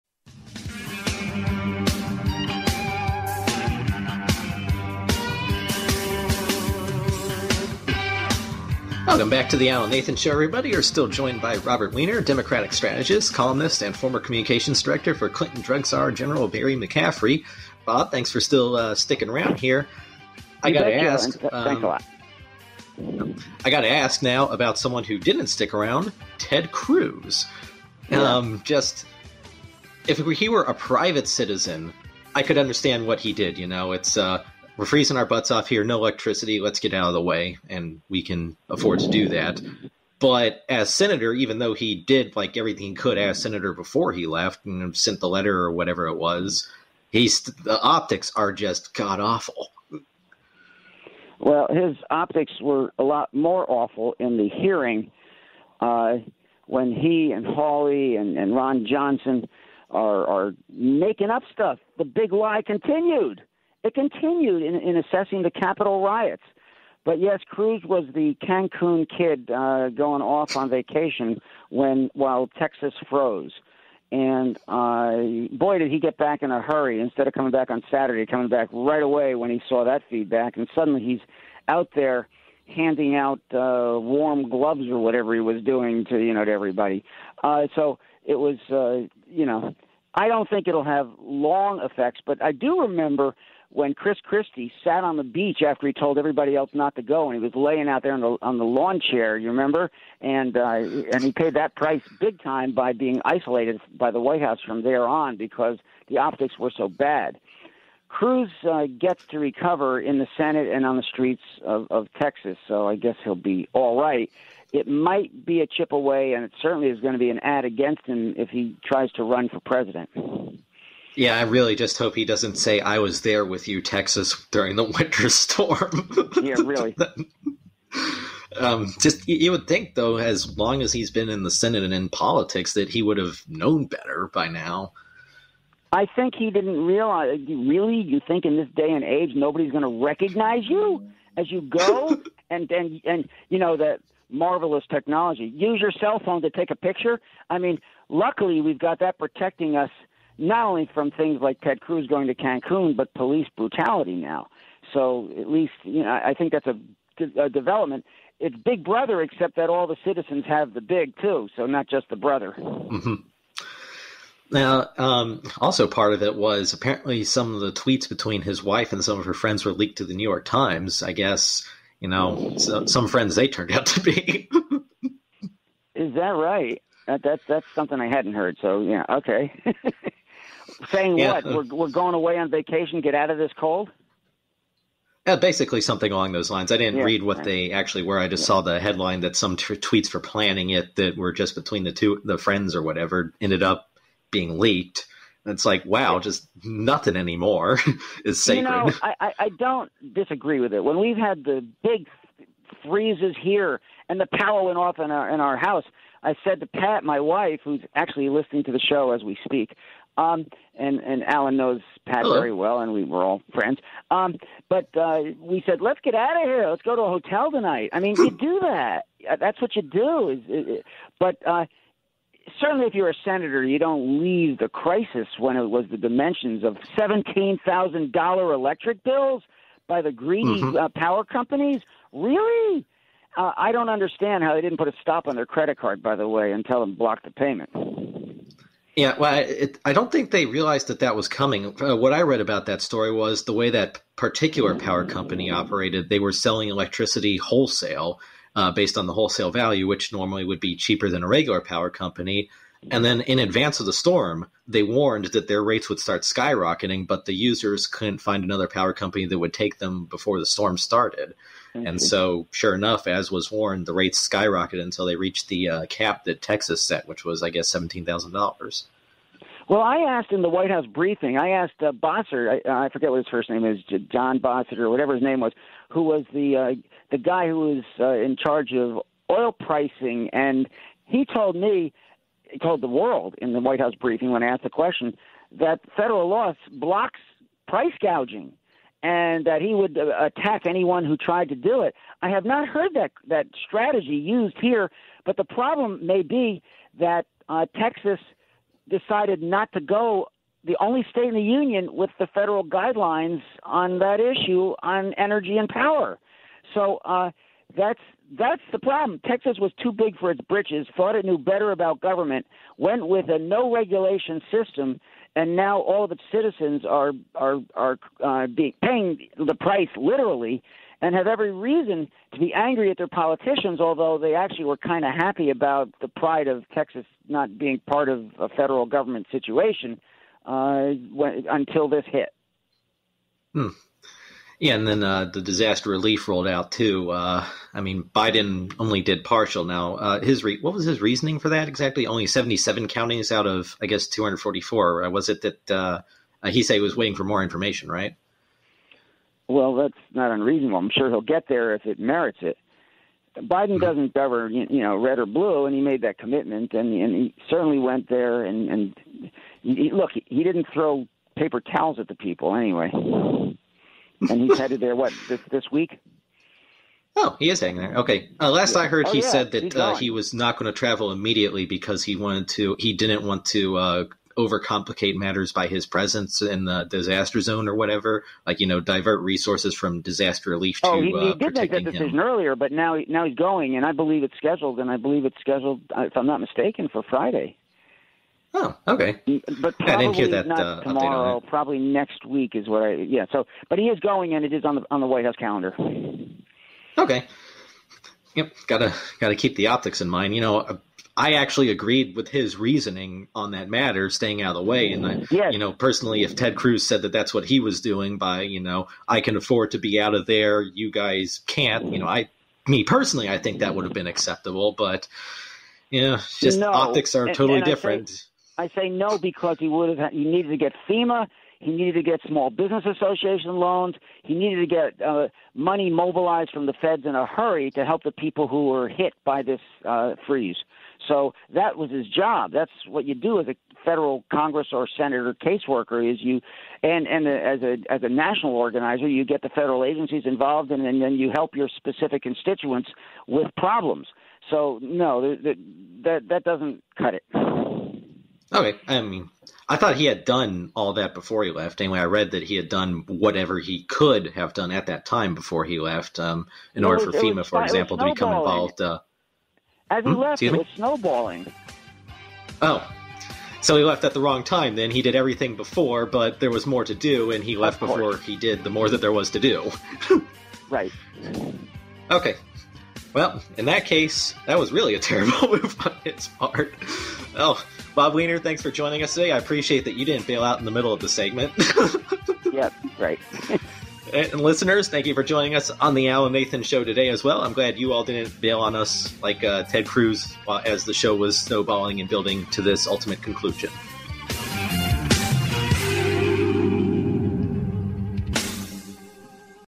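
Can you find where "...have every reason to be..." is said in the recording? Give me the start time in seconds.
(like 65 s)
321 s.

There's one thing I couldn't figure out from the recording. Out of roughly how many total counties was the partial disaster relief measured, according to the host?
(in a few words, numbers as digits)
244.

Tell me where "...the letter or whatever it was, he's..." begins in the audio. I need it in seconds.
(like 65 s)
45 s.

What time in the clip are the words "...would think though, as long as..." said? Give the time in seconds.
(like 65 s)
129 s.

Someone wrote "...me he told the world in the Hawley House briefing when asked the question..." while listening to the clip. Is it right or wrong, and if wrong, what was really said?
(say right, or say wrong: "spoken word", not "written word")
wrong: "White", not "Hawley".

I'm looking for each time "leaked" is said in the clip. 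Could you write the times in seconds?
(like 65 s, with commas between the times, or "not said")
169 s, 194 s.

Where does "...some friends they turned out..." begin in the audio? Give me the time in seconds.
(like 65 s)
172 s.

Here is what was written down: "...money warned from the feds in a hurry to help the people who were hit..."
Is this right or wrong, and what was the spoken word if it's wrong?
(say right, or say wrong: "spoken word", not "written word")
wrong: "mobilized", not "warned".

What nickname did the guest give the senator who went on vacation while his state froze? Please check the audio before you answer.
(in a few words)
the Cancun kid.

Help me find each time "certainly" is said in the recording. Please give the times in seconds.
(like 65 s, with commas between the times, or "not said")
116 s, 222 s, 357 s.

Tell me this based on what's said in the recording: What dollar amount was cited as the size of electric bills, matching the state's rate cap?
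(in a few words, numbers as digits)
$17,000.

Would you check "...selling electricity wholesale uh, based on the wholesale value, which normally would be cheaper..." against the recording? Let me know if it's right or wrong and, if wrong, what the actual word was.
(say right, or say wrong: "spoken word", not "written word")
right.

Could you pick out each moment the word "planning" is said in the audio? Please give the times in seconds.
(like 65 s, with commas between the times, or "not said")
190 s.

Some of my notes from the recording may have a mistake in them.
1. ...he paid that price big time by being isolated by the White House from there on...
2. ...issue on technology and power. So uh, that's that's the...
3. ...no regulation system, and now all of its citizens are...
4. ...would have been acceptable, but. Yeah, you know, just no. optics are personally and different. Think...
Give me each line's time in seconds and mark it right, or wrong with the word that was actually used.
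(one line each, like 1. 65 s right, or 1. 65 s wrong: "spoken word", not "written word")
1. 101 s right
2. 304 s wrong: "energy", not "technology"
3. 313 s right
4. 413 s wrong: "totally", not "personally".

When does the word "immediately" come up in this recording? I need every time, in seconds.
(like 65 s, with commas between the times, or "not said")
371 s.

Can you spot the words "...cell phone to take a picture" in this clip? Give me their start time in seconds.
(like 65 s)
145 s.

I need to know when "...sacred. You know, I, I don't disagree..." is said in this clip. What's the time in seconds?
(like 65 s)
198 s.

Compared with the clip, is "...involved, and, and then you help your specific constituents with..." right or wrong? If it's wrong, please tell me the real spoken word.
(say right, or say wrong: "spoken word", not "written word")
right.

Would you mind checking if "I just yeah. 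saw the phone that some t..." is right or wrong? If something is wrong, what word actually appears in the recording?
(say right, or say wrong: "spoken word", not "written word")
wrong: "headline", not "phone".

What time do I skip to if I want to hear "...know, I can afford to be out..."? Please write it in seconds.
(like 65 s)
408 s.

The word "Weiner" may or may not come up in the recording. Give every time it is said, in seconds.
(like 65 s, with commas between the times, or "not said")
11 s, 478 s.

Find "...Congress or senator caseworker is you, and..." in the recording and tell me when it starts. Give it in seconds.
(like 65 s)
434 s.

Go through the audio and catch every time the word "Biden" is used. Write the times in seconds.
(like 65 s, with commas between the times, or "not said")
338 s, 353 s.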